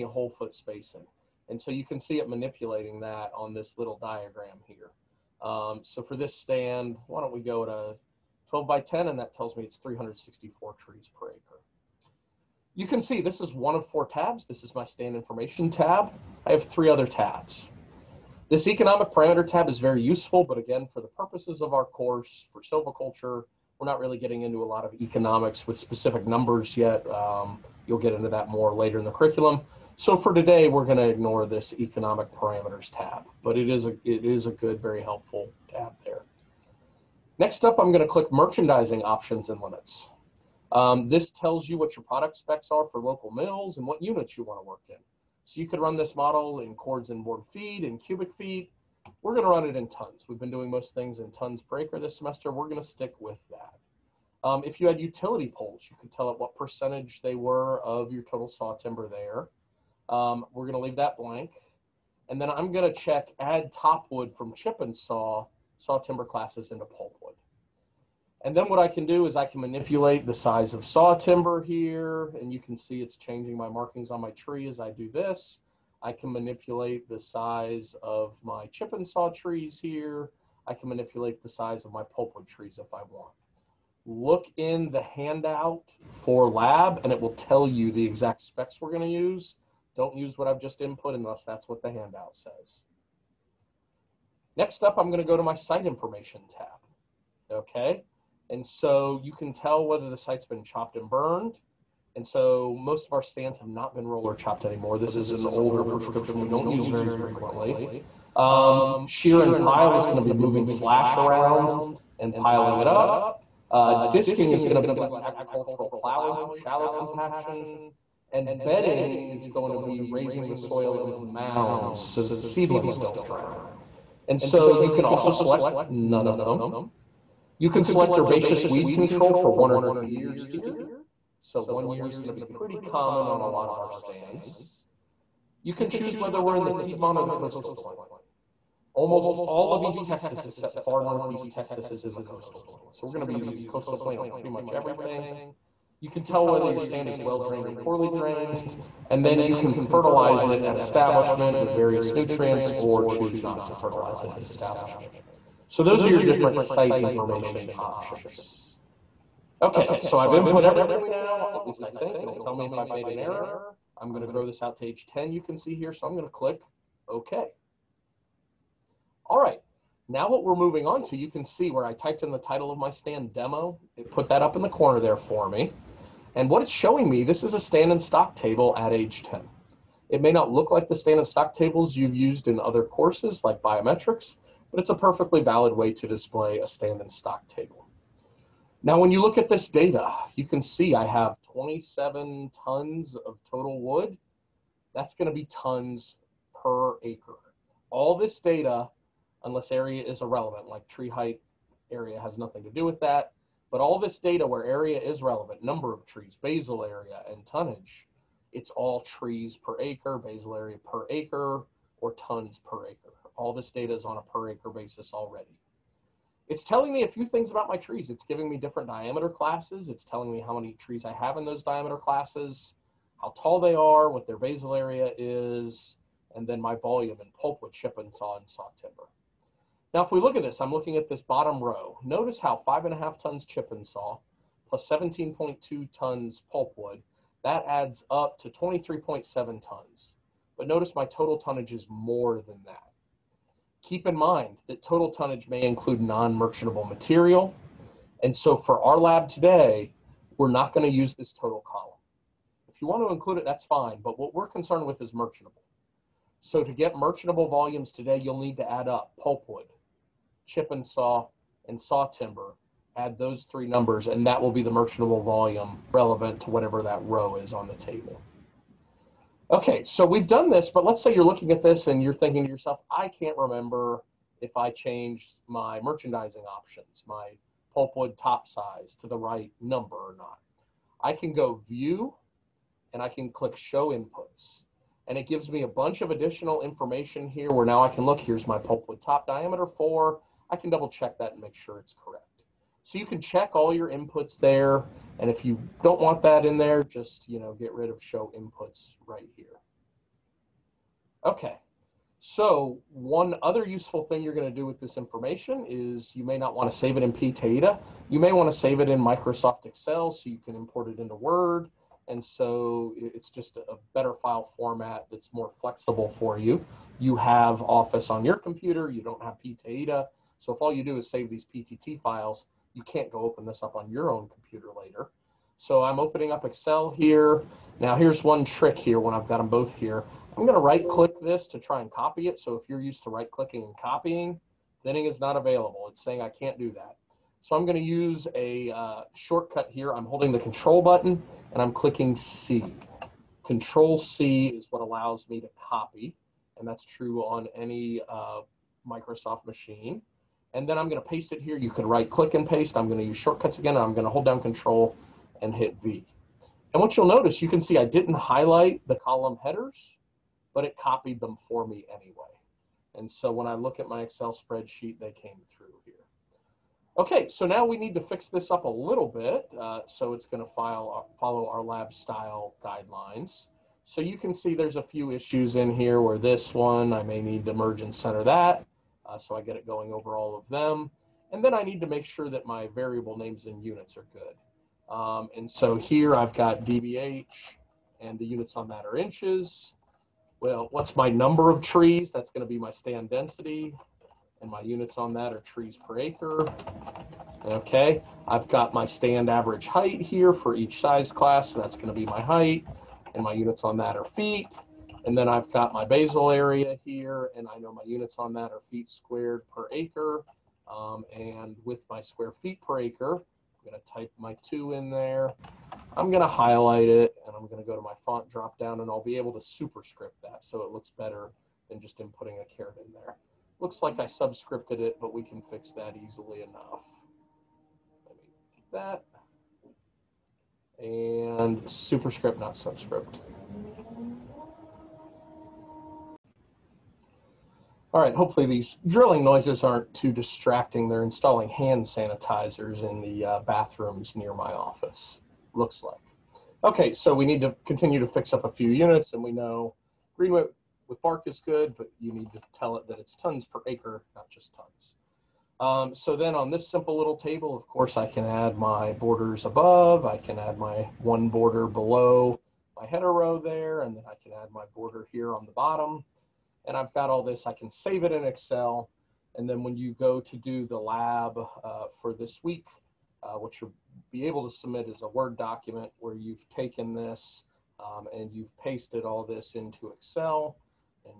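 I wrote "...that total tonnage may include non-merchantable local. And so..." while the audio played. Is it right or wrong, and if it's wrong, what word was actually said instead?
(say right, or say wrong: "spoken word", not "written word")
wrong: "material", not "local".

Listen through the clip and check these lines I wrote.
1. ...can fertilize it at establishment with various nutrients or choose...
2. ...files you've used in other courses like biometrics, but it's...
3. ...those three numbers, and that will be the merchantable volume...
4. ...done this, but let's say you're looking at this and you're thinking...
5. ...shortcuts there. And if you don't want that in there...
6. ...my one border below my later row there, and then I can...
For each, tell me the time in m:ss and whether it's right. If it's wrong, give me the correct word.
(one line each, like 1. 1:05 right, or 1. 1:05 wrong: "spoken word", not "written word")
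1. 2:29 right
2. 3:01 wrong: "tables", not "files"
3. 4:23 right
4. 4:30 right
5. 4:53 wrong: "inputs", not "shortcuts"
6. 7:40 wrong: "header", not "later".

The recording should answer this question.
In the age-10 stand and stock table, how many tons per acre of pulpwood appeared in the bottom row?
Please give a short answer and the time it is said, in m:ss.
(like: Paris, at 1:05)
17.2, at 3:54.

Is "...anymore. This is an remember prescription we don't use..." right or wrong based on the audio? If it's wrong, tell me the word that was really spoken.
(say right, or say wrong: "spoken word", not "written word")
wrong: "older", not "remember".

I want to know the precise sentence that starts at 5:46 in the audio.
And that's true on any uh, Microsoft machine and then I'm going to paste it here.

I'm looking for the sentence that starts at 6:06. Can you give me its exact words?
Okay, so now we need to fix this up a little bit.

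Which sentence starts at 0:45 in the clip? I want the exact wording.
So you could run this model in cords and board feet and cubic feet.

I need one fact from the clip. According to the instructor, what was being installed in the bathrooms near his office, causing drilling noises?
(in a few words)
hand sanitizers.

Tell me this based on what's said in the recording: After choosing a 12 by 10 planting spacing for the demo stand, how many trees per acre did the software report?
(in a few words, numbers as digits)
364.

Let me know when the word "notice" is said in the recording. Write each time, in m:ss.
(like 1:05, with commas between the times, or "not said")
3:52, 4:00, 5:57.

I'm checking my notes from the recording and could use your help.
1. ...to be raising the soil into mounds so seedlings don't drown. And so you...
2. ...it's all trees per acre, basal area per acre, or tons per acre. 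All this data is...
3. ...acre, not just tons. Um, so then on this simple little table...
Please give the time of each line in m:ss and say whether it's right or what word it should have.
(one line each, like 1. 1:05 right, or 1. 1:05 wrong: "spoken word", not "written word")
1. 1:59 right
2. 3:28 right
3. 7:33 right.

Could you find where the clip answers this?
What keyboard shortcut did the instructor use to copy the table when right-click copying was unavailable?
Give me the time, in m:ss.
5:43.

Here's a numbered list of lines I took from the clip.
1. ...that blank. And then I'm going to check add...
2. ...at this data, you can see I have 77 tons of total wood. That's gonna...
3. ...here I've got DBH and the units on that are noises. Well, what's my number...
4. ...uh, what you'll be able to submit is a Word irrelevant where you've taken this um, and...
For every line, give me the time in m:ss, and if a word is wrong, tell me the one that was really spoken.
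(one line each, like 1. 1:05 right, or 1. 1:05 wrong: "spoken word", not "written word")
1. 1:00 right
2. 3:09 wrong: "27", not "77"
3. 6:25 wrong: "inches", not "noises"
4. 7:53 wrong: "document", not "irrelevant".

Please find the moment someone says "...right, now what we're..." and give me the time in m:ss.
2:49.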